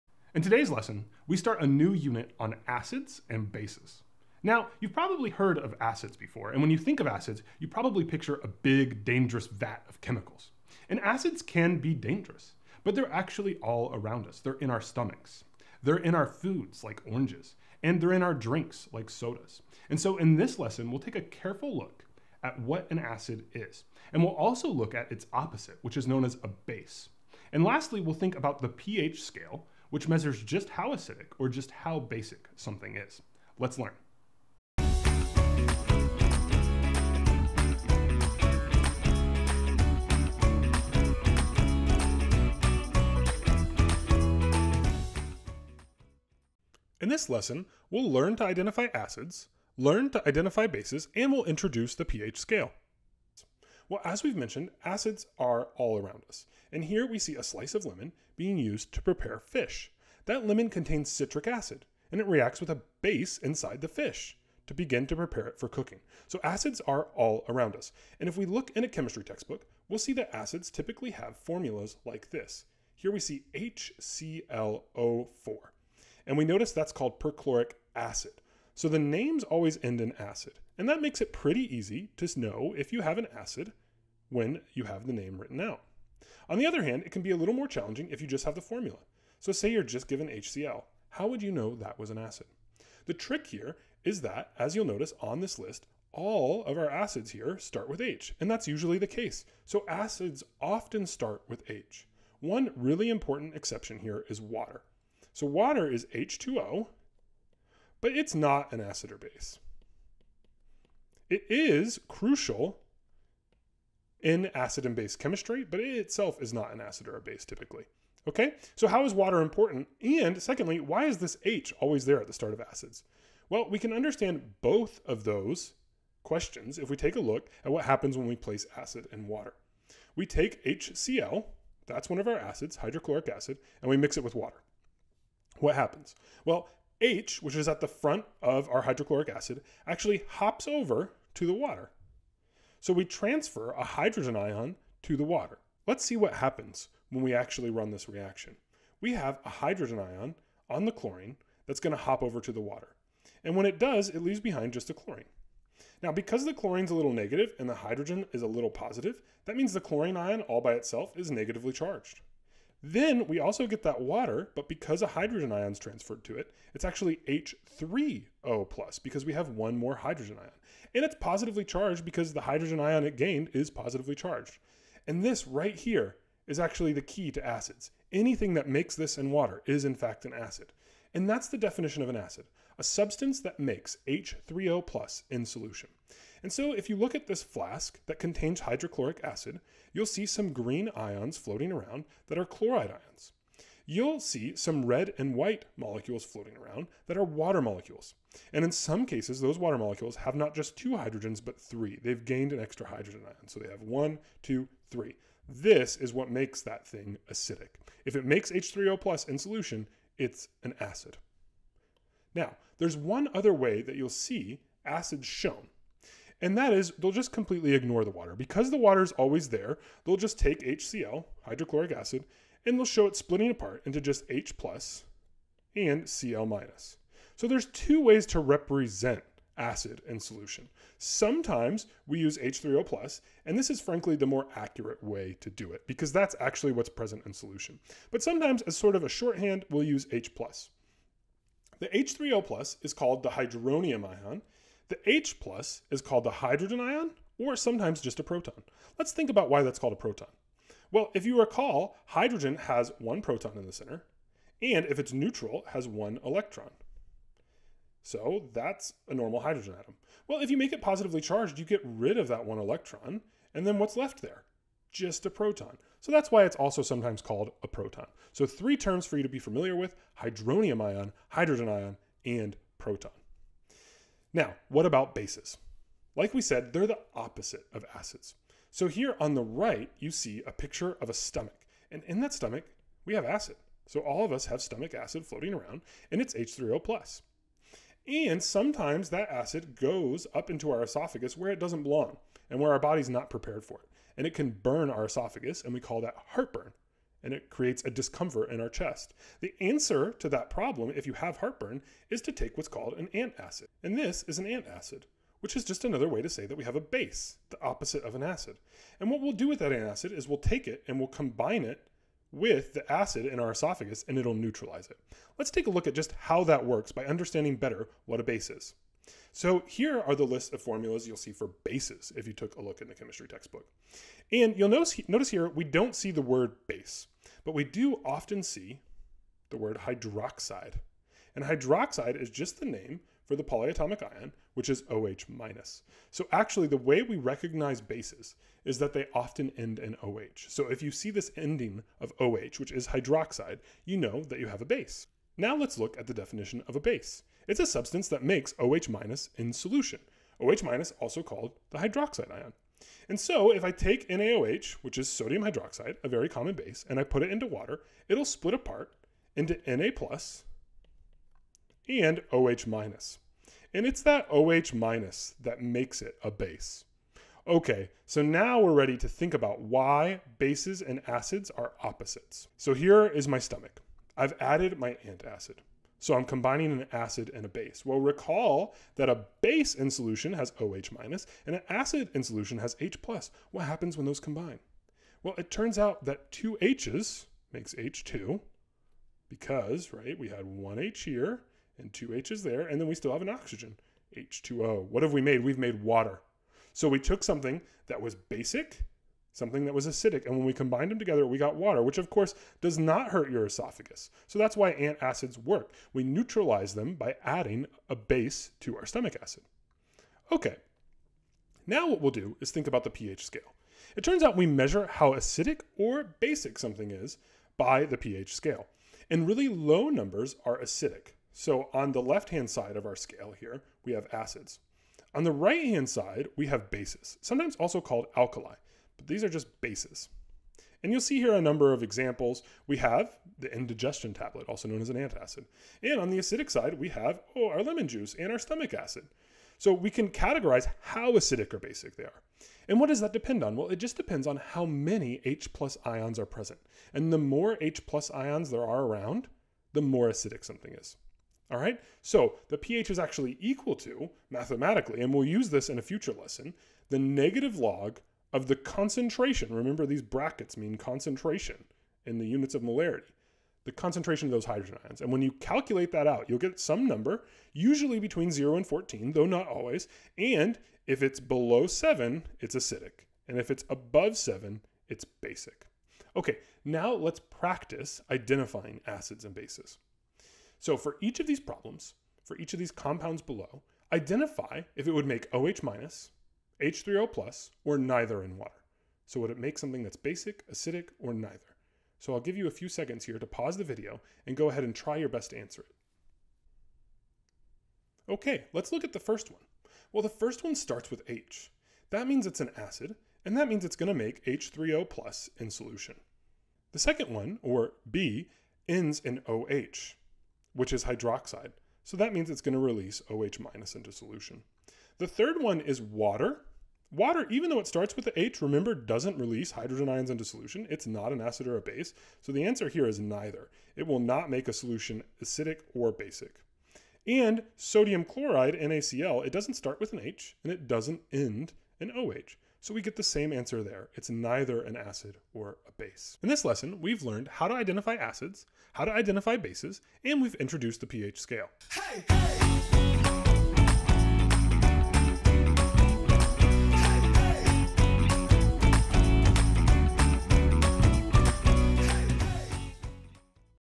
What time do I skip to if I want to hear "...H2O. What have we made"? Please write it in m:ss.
6:34.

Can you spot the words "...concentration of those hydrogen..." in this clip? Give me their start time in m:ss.
7:43.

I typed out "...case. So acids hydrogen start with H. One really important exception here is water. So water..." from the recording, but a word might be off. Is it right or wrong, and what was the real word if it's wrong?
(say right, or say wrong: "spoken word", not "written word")
wrong: "often", not "hydrogen".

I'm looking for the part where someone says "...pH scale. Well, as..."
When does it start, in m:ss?
0:52.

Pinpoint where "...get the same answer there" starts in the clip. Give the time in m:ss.
8:52.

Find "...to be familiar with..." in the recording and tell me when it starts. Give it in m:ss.
4:29.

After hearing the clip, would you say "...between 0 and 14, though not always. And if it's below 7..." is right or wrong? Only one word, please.
right.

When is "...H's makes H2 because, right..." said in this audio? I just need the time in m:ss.
6:26.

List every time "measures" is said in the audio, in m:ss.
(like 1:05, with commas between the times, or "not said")
0:30, 6:54.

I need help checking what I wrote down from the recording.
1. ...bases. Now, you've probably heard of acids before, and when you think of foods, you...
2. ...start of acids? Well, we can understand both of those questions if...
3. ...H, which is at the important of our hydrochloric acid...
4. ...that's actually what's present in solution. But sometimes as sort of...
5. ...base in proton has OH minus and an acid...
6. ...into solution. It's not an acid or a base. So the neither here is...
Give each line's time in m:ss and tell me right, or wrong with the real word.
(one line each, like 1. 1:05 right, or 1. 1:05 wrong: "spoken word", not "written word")
1. 0:03 wrong: "acids", not "foods"
2. 2:02 right
3. 2:17 wrong: "front", not "important"
4. 3:56 right
5. 6:19 wrong: "solution", not "proton"
6. 8:40 wrong: "answer", not "neither".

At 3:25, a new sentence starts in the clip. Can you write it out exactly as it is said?
This is what makes that thing acidic.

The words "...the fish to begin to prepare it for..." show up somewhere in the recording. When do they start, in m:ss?
1:03.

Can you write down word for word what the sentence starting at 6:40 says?
And when we combined them together, we got water, which of course does not hurt your esophagus.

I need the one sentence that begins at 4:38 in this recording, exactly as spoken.
So here on the right, you see a picture of a stomach.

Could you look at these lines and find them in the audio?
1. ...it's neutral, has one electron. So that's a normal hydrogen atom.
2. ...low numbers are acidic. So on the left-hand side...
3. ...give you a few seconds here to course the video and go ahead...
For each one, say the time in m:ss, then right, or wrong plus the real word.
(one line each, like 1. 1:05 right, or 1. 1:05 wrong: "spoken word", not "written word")
1. 4:14 right
2. 6:59 right
3. 8:12 wrong: "pause", not "course".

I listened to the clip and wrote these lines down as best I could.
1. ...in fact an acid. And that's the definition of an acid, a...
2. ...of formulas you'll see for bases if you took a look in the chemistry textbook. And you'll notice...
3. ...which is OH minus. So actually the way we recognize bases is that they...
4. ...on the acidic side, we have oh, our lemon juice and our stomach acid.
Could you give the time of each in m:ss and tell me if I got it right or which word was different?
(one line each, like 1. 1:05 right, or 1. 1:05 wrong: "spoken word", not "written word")
1. 2:59 right
2. 5:20 right
3. 5:34 right
4. 7:15 right.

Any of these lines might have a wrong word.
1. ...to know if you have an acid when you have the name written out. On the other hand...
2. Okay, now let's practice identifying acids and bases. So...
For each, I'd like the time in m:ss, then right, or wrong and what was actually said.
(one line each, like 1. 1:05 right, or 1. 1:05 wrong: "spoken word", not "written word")
1. 1:22 right
2. 7:56 right.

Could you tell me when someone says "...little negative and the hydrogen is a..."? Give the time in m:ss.
2:36.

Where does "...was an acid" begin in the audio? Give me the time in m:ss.
1:31.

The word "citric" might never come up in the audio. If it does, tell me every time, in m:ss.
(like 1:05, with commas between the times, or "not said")
1:01.